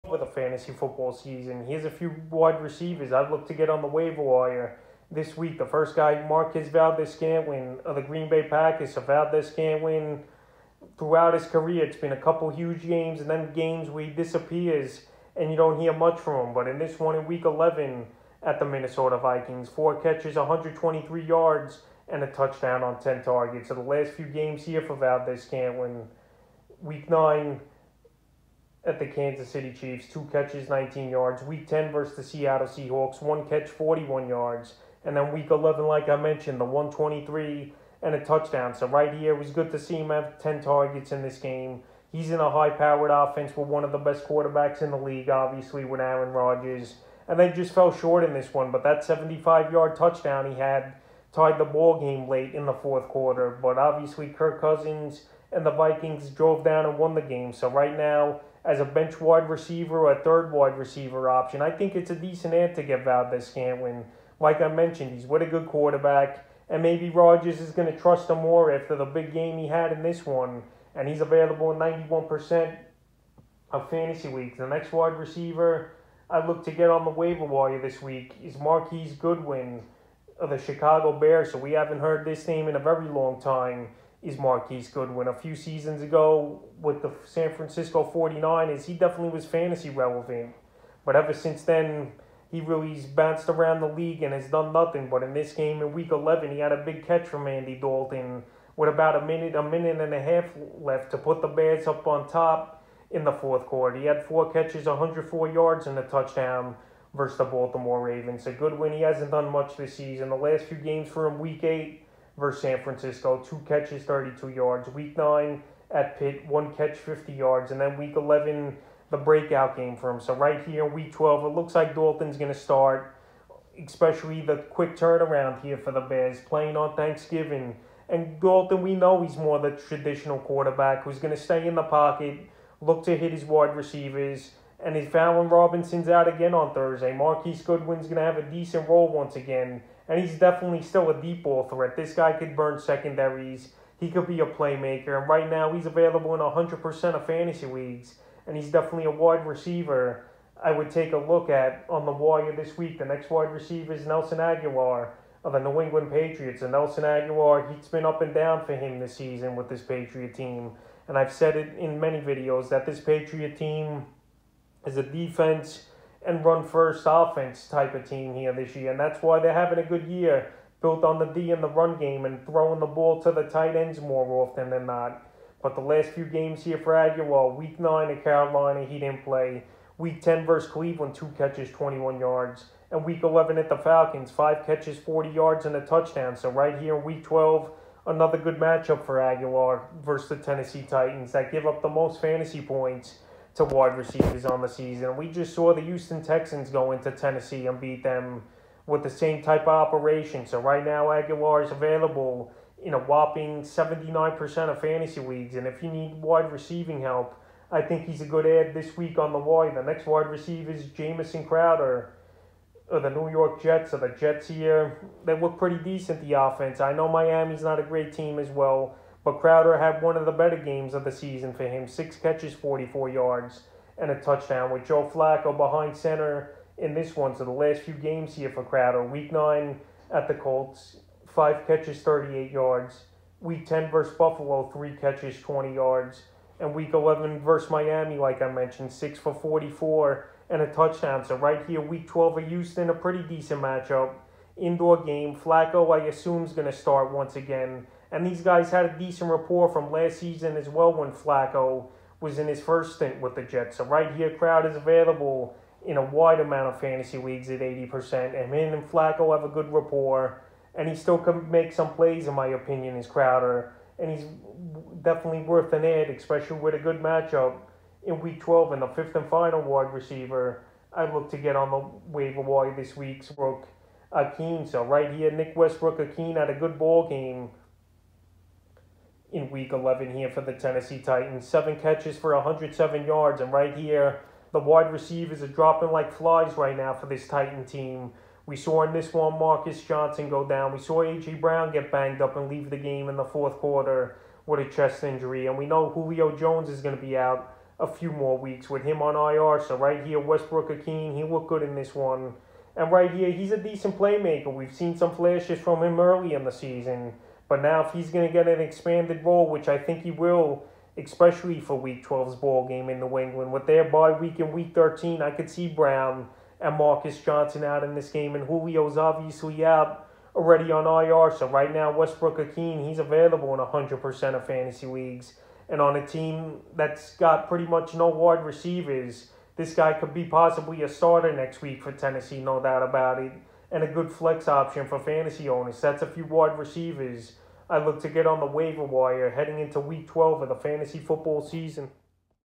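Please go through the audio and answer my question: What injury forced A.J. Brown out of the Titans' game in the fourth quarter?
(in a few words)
chest injury.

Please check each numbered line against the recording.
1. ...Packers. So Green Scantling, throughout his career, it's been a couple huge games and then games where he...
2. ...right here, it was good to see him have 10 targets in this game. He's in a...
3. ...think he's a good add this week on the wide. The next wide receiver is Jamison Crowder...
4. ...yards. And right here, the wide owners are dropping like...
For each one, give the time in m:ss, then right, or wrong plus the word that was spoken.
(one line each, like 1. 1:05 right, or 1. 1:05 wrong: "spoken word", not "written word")
1. 0:08 wrong: "Valdes", not "Green"
2. 0:38 right
3. 3:27 right
4. 4:43 wrong: "receivers", not "owners".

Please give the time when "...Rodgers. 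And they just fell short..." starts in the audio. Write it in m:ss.
0:46.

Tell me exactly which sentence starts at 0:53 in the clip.
But obviously, Kirk Cousins and the Vikings drove down and won the game.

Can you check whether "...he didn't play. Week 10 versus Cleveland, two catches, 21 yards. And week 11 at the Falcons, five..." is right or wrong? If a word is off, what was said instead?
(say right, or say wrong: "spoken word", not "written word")
right.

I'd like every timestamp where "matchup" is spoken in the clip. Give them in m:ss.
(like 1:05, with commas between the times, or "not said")
3:08, 4:03, 4:27.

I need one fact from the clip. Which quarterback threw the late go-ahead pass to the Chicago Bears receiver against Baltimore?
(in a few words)
Andy Dalton.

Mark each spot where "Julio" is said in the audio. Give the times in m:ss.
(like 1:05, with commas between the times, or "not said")
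4:55, 5:18.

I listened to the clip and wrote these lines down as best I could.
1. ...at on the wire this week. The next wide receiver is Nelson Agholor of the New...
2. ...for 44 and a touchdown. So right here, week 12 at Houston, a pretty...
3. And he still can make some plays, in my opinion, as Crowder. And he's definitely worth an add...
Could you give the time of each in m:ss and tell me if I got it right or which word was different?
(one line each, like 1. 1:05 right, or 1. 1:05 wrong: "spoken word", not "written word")
1. 2:31 right
2. 3:59 right
3. 4:20 right.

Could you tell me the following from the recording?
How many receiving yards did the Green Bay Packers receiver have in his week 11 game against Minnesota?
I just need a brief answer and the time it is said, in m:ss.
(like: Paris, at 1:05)
123, at 0:20.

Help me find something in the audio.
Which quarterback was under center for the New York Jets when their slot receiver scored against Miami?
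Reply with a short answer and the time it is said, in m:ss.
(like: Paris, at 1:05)
Joe Flacco, at 3:44.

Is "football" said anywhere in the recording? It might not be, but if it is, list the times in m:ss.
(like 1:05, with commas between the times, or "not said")
0:00, 5:40.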